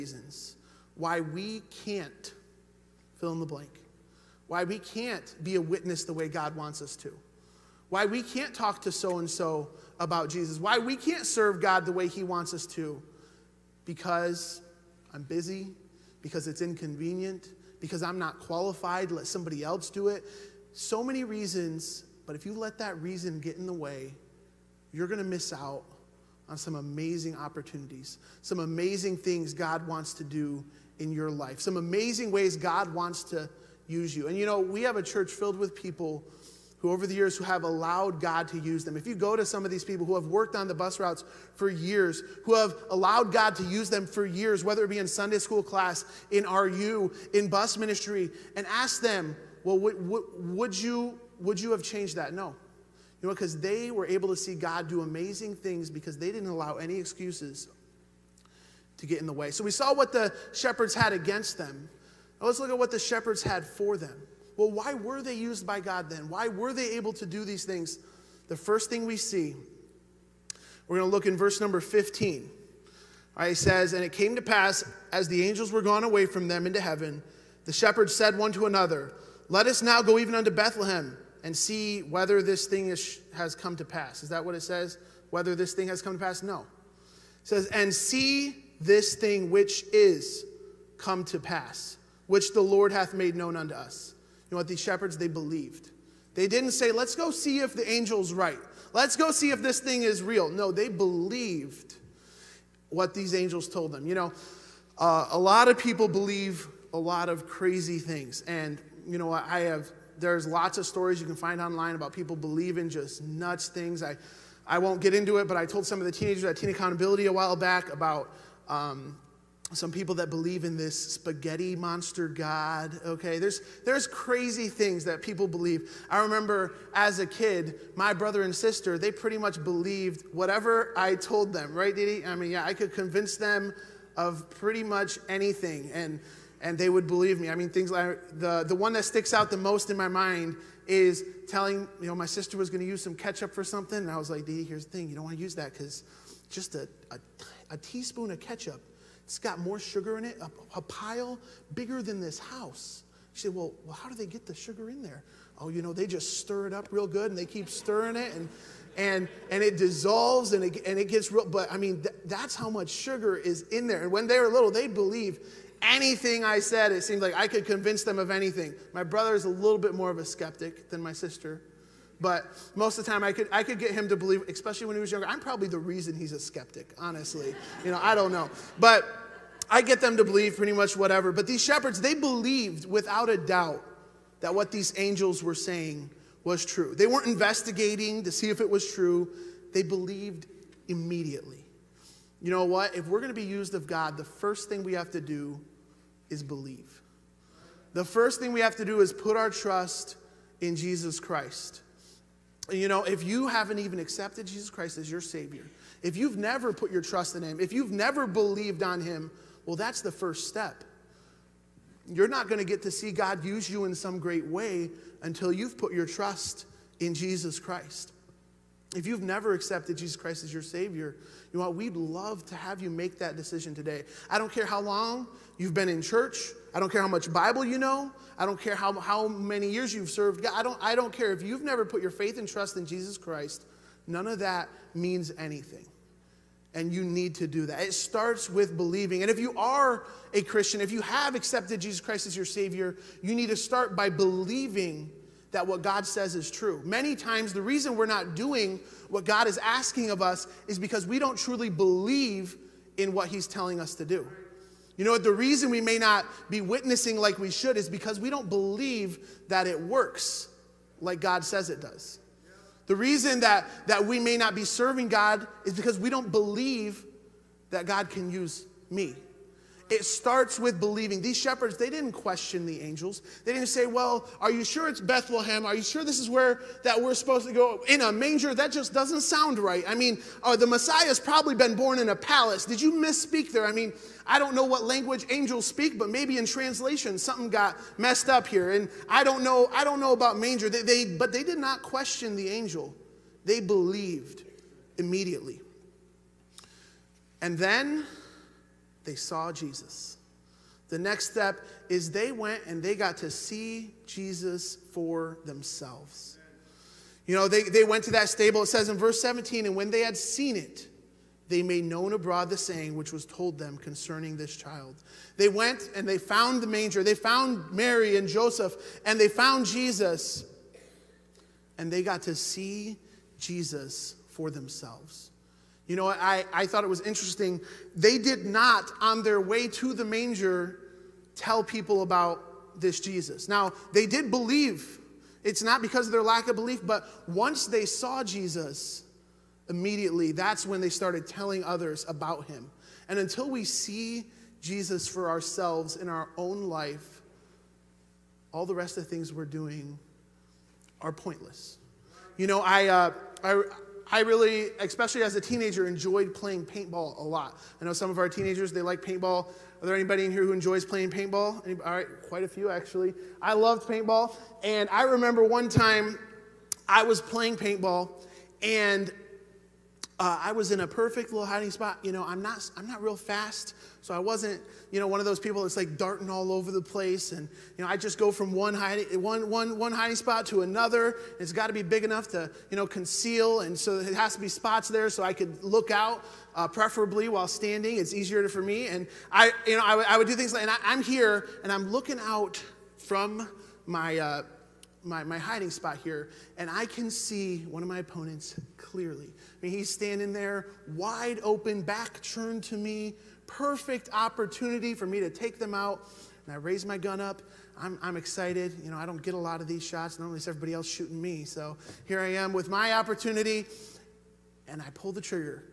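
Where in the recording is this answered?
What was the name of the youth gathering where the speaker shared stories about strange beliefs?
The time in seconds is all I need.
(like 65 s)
116 s.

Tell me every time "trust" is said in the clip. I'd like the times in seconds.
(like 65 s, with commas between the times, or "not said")
199 s, 207 s, 216 s, 232 s.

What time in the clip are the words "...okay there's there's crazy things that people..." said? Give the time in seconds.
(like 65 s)
123 s.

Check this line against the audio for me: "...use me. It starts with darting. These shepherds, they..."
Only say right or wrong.
wrong.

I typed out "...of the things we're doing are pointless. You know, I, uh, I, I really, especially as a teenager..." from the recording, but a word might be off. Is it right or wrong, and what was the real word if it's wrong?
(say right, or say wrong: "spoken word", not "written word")
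right.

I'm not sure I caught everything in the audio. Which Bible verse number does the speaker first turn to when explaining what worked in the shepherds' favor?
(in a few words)
15.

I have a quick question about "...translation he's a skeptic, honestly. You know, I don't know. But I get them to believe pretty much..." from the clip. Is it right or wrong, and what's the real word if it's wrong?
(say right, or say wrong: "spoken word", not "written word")
wrong: "reason", not "translation".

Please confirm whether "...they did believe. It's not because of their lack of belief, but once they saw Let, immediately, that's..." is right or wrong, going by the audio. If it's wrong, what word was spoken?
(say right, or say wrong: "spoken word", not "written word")
wrong: "Jesus", not "Let".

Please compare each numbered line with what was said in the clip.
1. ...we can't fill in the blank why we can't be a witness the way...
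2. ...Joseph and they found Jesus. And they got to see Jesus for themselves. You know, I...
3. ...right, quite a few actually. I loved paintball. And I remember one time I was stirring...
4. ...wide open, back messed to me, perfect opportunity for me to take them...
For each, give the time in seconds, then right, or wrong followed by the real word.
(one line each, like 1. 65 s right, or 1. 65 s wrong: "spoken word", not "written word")
1. 1 s right
2. 318 s right
3. 361 s wrong: "playing", not "stirring"
4. 400 s wrong: "turned", not "messed".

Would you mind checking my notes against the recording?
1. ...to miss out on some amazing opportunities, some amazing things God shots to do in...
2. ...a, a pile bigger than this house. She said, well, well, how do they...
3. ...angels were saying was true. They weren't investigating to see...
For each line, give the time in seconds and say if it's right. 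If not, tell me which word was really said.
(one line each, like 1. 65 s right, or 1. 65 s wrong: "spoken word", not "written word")
1. 25 s wrong: "wants", not "shots"
2. 150 s right
3. 184 s right.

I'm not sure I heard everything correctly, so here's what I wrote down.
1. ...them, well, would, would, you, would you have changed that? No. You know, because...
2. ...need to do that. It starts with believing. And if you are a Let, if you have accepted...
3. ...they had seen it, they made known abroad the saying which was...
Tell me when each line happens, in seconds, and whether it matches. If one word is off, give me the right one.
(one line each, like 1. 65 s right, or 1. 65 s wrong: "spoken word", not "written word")
1. 49 s right
2. 237 s wrong: "Christian", not "Let"
3. 309 s right.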